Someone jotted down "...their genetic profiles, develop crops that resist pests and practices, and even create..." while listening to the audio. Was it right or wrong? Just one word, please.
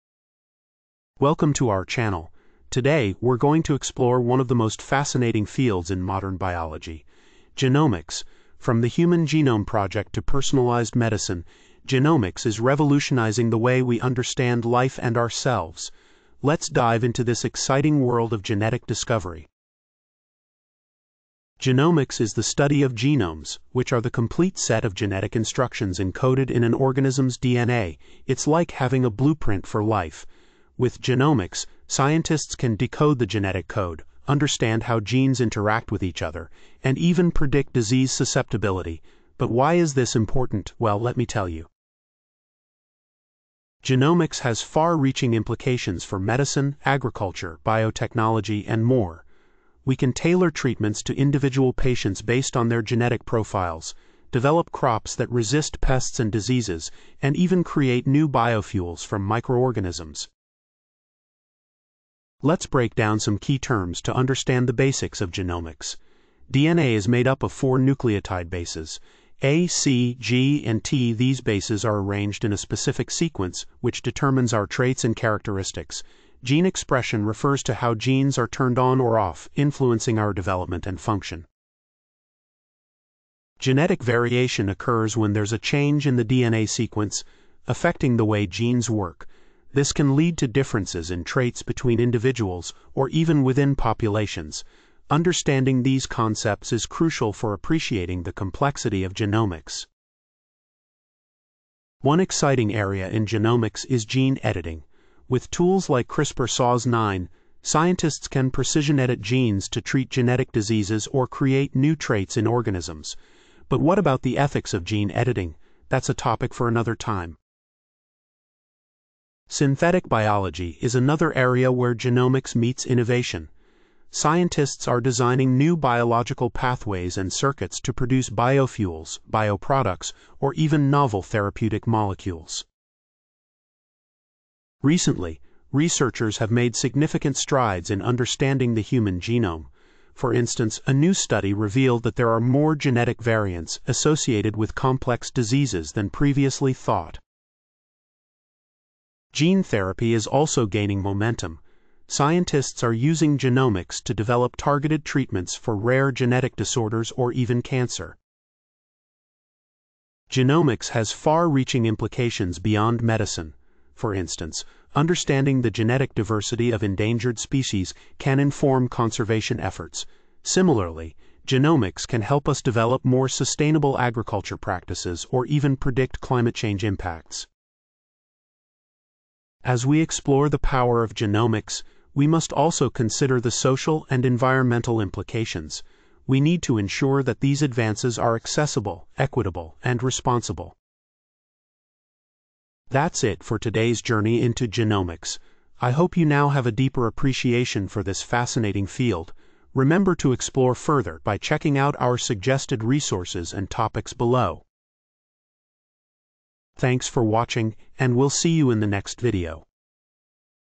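wrong.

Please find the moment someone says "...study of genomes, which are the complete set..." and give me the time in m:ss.
0:22.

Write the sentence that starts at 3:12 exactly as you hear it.
That's it for today's journey into genomics.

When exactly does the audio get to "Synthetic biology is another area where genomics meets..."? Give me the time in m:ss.
1:59.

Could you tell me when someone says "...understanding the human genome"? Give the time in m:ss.
2:18.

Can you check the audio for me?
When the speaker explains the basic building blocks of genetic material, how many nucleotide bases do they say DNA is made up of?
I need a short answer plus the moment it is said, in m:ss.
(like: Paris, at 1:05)
4, at 1:07.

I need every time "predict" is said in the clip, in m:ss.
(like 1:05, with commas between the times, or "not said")
0:37, 2:55.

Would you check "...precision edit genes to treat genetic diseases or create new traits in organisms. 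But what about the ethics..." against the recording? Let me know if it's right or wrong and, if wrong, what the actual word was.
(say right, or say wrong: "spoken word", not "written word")
right.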